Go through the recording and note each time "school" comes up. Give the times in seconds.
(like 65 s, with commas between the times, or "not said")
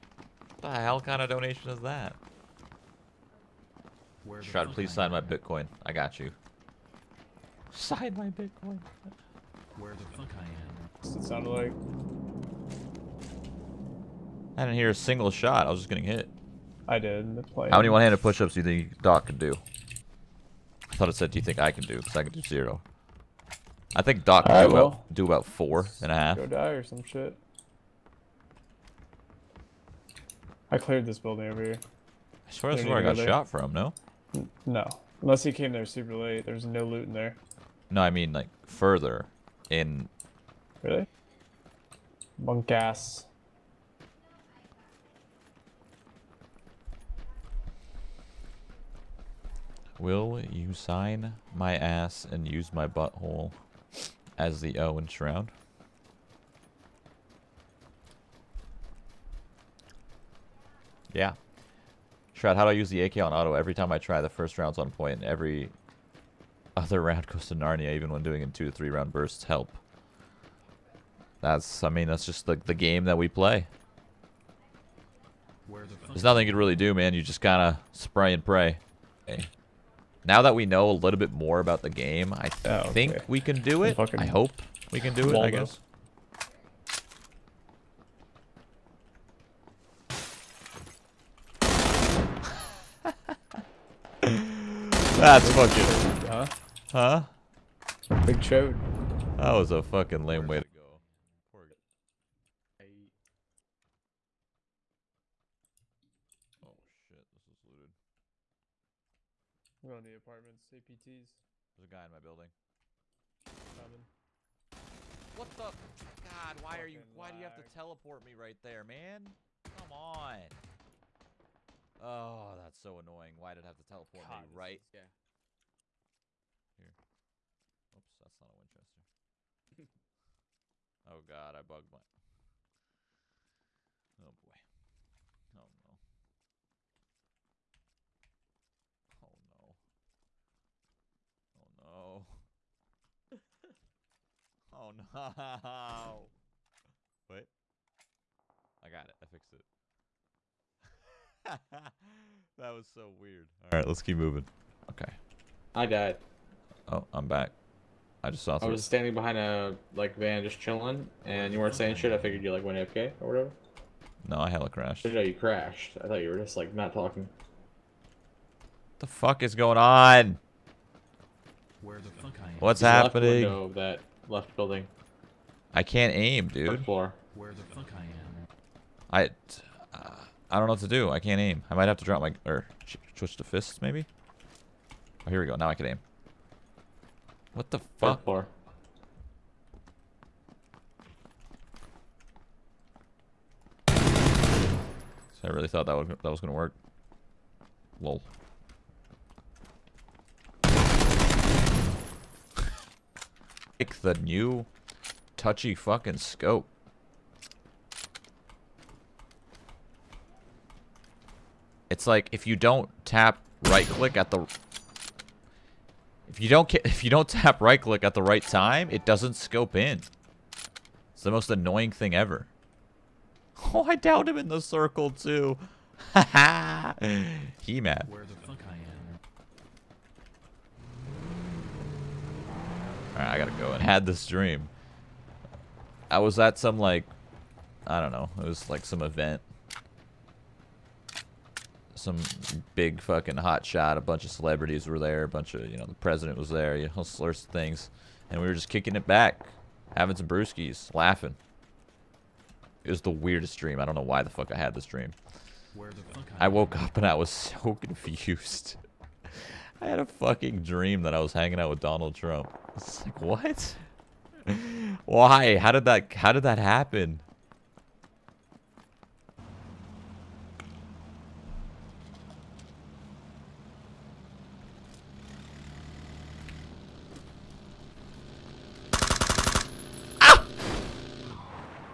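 not said.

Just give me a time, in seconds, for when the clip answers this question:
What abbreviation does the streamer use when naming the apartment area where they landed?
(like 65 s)
110 s.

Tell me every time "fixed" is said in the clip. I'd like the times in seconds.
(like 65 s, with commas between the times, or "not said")
149 s.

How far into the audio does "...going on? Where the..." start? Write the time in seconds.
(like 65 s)
169 s.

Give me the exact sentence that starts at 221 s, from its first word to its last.
It's the most annoying thing ever.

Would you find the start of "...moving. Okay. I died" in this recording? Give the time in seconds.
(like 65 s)
154 s.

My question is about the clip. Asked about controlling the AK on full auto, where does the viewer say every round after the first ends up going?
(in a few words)
Narnia.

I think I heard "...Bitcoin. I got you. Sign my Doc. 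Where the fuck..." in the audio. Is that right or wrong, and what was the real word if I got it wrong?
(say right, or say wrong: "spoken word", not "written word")
wrong: "Bitcoin", not "Doc".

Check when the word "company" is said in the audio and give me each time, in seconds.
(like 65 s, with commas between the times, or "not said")
not said.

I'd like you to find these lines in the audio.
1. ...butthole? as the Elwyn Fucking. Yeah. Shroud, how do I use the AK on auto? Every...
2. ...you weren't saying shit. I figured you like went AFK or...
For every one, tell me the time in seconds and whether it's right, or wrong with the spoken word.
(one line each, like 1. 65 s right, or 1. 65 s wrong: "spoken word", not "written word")
1. 52 s wrong: "Shroud", not "Fucking"
2. 161 s right.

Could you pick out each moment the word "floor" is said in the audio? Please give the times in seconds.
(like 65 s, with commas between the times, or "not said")
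176 s, 188 s.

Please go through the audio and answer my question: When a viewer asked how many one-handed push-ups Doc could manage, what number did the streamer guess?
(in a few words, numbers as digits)
4 and a half.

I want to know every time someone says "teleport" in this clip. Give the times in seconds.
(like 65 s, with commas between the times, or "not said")
117 s, 123 s.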